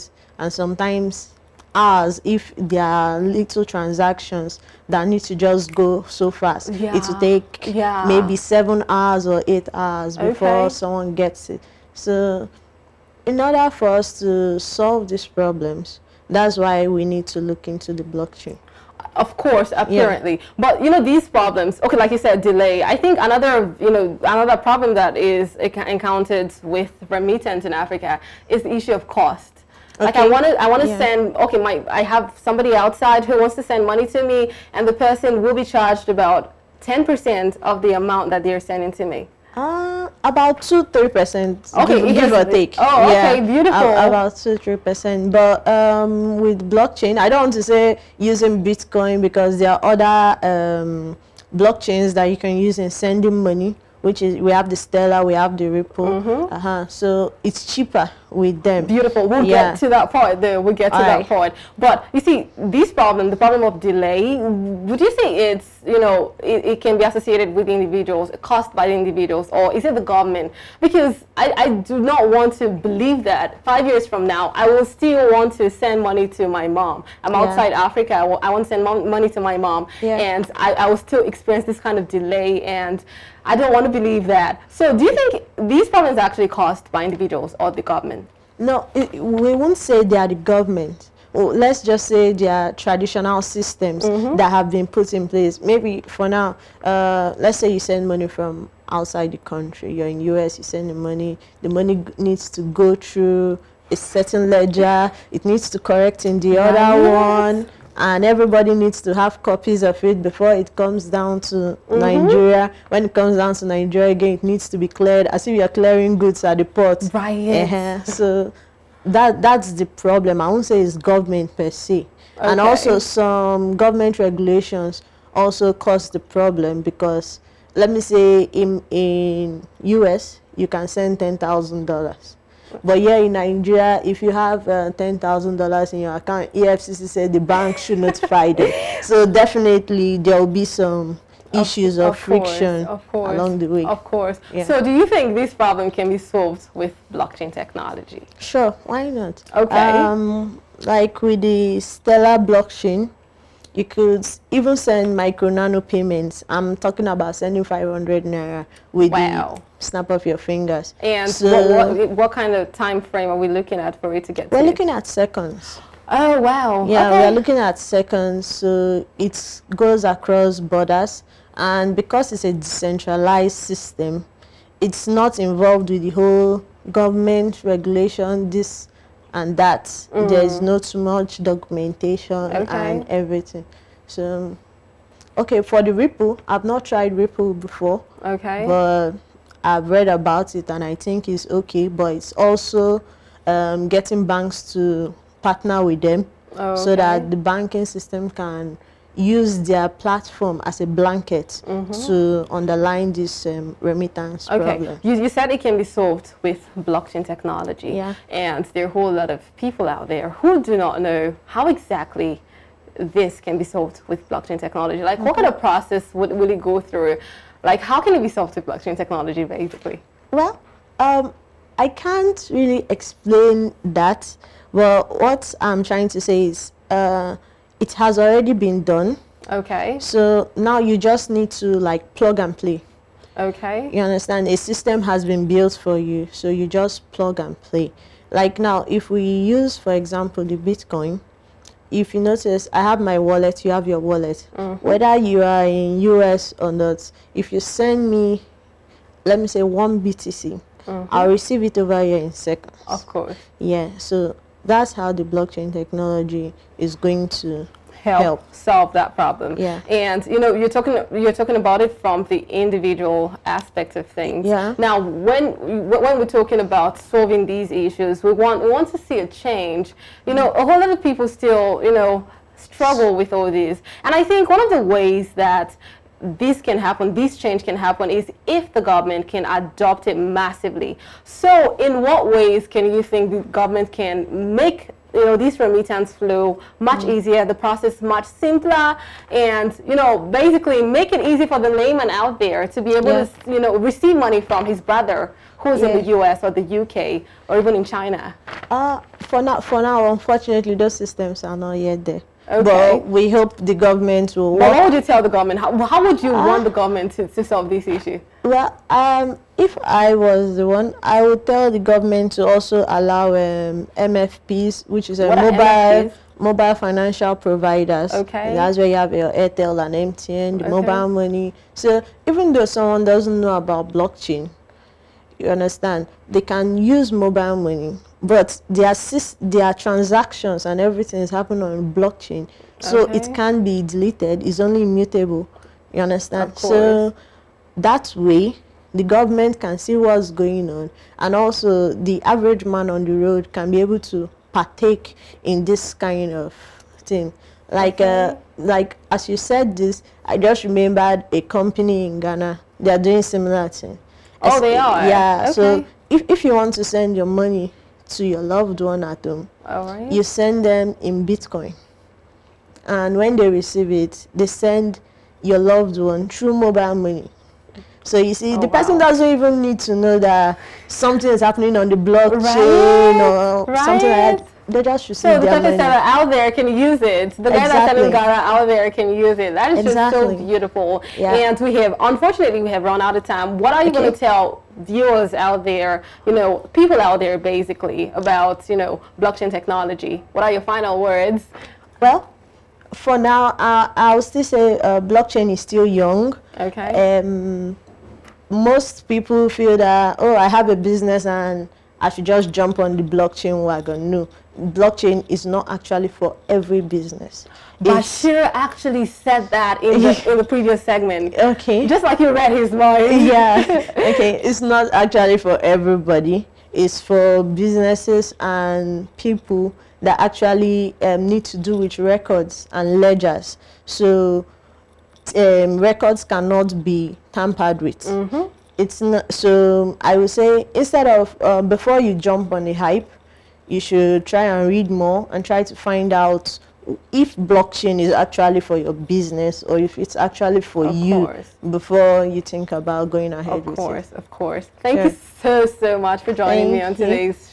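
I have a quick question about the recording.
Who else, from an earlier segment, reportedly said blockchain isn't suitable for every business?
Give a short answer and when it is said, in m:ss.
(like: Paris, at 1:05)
Bashir, at 6:47.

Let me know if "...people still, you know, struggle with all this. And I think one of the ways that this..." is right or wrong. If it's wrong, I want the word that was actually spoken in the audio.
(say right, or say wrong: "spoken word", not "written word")
right.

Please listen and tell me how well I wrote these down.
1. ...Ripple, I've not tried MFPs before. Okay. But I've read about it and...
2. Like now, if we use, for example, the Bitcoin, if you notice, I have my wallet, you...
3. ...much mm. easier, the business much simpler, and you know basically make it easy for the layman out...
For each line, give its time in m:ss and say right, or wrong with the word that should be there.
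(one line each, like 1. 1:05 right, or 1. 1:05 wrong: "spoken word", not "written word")
1. 3:05 wrong: "Ripple", not "MFPs"
2. 3:58 right
3. 4:46 wrong: "process", not "business".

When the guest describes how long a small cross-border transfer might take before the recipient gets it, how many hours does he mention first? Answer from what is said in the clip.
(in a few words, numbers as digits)
7.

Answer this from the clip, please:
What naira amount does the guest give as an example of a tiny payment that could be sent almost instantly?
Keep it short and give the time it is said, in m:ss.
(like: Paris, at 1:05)
500 naira, at 2:37.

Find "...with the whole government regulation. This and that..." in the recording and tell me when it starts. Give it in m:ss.
2:55.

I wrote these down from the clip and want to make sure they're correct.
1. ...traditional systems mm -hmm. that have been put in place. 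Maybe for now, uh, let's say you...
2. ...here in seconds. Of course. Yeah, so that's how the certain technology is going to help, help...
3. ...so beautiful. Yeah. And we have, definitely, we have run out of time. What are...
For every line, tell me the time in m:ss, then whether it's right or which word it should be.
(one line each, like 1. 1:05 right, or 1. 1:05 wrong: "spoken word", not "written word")
1. 1:32 right
2. 4:12 wrong: "blockchain", not "certain"
3. 6:20 wrong: "unfortunately", not "definitely".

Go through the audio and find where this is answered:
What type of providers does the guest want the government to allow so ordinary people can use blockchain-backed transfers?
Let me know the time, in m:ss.
5:16.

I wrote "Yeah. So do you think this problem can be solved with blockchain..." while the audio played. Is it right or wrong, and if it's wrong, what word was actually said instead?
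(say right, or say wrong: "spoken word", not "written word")
right.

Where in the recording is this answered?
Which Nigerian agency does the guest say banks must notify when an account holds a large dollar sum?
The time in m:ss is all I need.
2:16.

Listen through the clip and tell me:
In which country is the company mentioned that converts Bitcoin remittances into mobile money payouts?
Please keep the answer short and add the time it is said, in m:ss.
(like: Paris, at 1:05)
Ghana, at 5:52.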